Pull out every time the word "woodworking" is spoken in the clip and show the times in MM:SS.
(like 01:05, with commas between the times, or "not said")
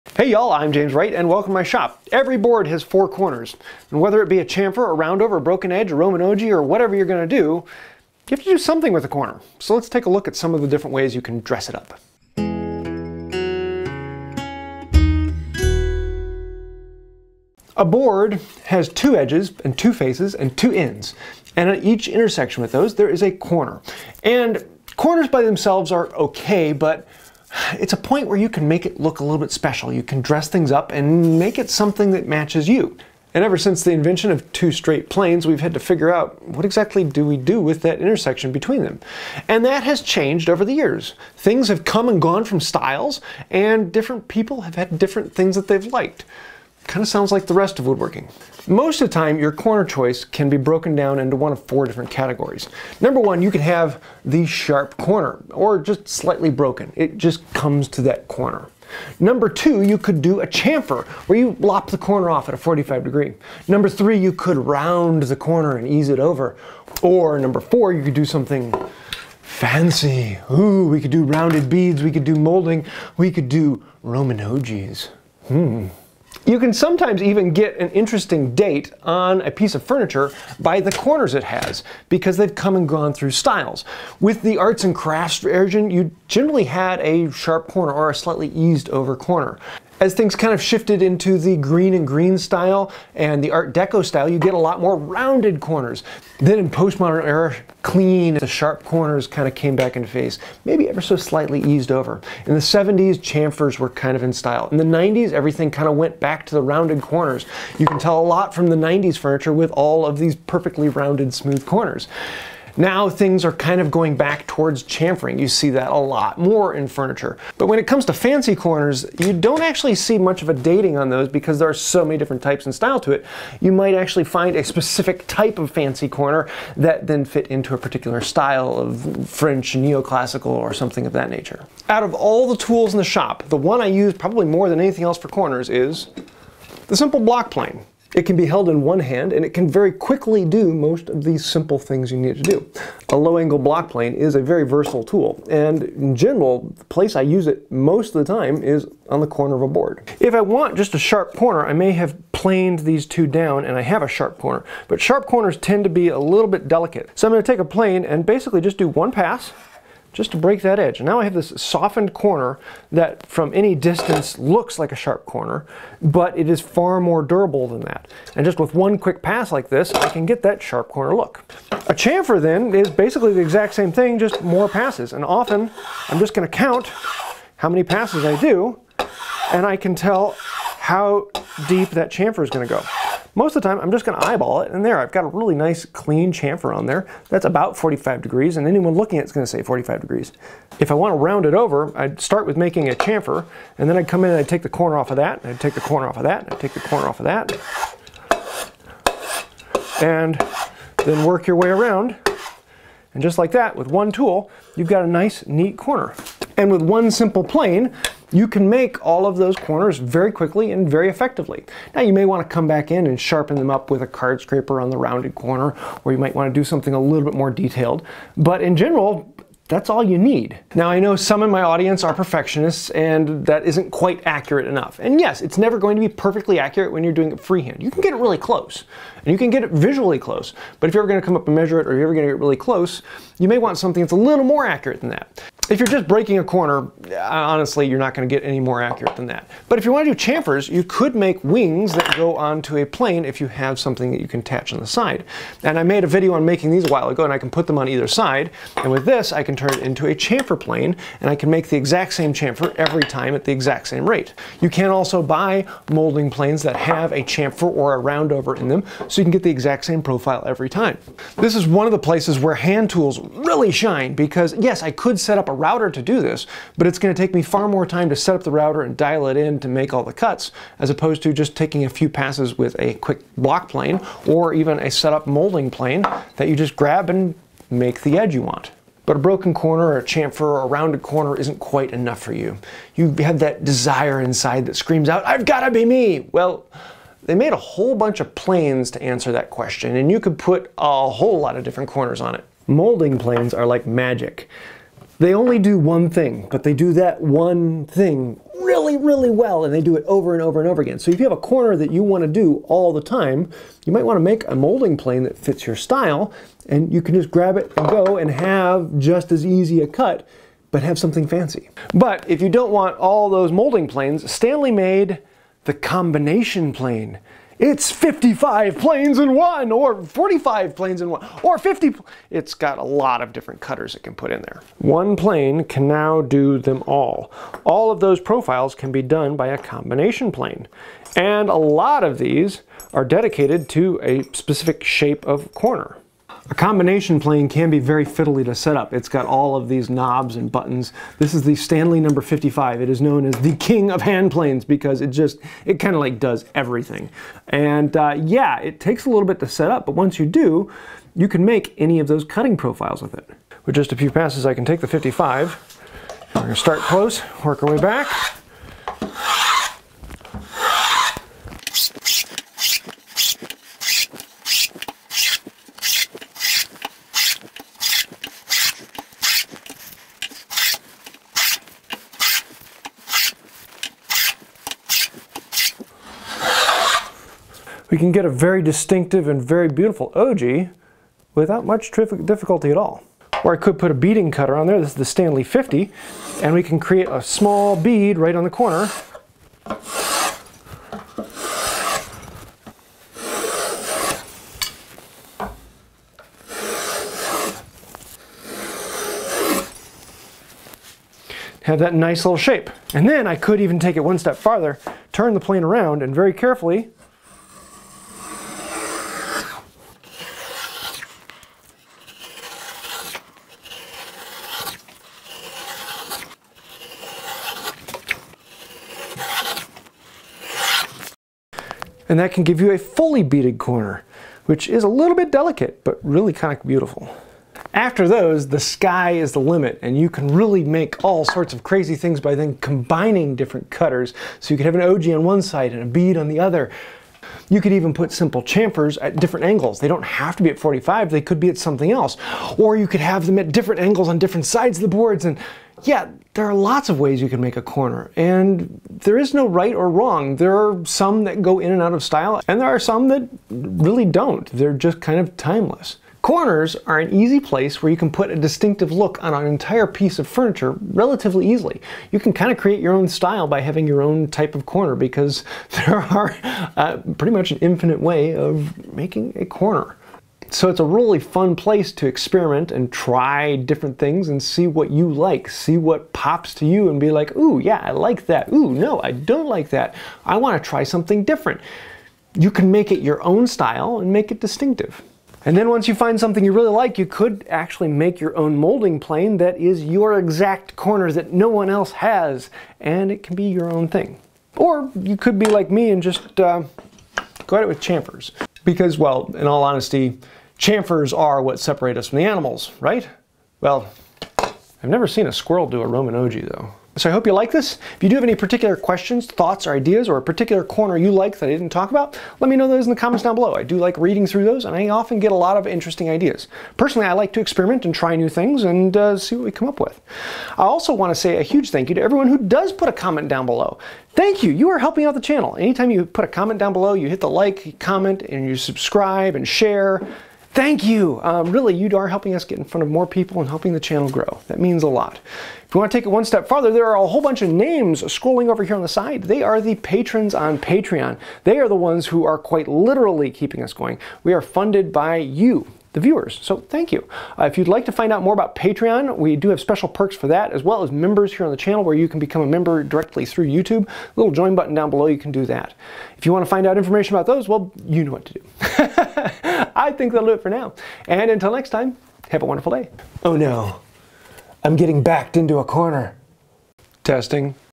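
00:47.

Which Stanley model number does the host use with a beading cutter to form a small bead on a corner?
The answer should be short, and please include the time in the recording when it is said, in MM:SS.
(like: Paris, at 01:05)
50, at 06:25.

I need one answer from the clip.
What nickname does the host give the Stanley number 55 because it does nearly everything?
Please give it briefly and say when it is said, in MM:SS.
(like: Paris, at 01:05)
King of hand planes, at 05:43.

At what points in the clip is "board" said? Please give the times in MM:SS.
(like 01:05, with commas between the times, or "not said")
00:02, 00:17, 02:29, 07:24.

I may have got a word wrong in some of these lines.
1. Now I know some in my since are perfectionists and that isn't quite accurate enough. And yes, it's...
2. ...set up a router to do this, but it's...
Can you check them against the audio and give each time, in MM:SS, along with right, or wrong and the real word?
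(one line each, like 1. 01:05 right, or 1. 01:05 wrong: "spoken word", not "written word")
1. 03:40 wrong: "audience", not "since"
2. 04:25 right.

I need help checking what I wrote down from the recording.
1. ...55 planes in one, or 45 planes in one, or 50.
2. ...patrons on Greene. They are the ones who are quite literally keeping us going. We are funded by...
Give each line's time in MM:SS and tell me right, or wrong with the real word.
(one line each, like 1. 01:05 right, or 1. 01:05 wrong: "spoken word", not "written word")
1. 05:17 right
2. 08:59 wrong: "Patreon", not "Greene".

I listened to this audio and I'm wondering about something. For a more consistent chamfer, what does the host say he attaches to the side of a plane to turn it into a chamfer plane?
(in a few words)
Wings.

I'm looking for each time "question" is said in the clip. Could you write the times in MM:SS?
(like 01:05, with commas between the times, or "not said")
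04:49, 08:28.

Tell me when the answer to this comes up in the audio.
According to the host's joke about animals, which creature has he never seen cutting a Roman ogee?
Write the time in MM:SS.
08:25.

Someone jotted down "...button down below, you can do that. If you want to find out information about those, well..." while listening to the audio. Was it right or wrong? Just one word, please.
right.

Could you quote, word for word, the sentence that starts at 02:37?
So I'm going to take a plane and basically just do one pass, just to break that edge.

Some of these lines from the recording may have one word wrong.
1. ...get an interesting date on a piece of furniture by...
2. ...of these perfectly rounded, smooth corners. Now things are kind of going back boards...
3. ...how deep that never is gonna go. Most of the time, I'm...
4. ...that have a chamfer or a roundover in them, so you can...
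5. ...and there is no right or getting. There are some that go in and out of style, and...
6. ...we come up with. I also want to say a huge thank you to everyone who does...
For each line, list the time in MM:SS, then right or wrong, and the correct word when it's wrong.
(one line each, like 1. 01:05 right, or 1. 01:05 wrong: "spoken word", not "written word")
1. 01:17 right
2. 01:50 wrong: "towards", not "boards"
3. 03:00 wrong: "chamfer", not "never"
4. 04:16 right
5. 07:28 wrong: "wrong", not "getting"
6. 08:39 right.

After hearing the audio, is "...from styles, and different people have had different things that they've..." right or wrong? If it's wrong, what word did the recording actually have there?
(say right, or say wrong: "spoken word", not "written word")
right.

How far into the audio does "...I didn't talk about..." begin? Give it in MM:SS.
08:31.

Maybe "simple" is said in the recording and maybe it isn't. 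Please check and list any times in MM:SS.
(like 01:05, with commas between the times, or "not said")
02:16, 02:21, 03:27, 07:18.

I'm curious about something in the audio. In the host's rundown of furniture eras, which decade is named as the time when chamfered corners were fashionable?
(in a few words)
The 70s.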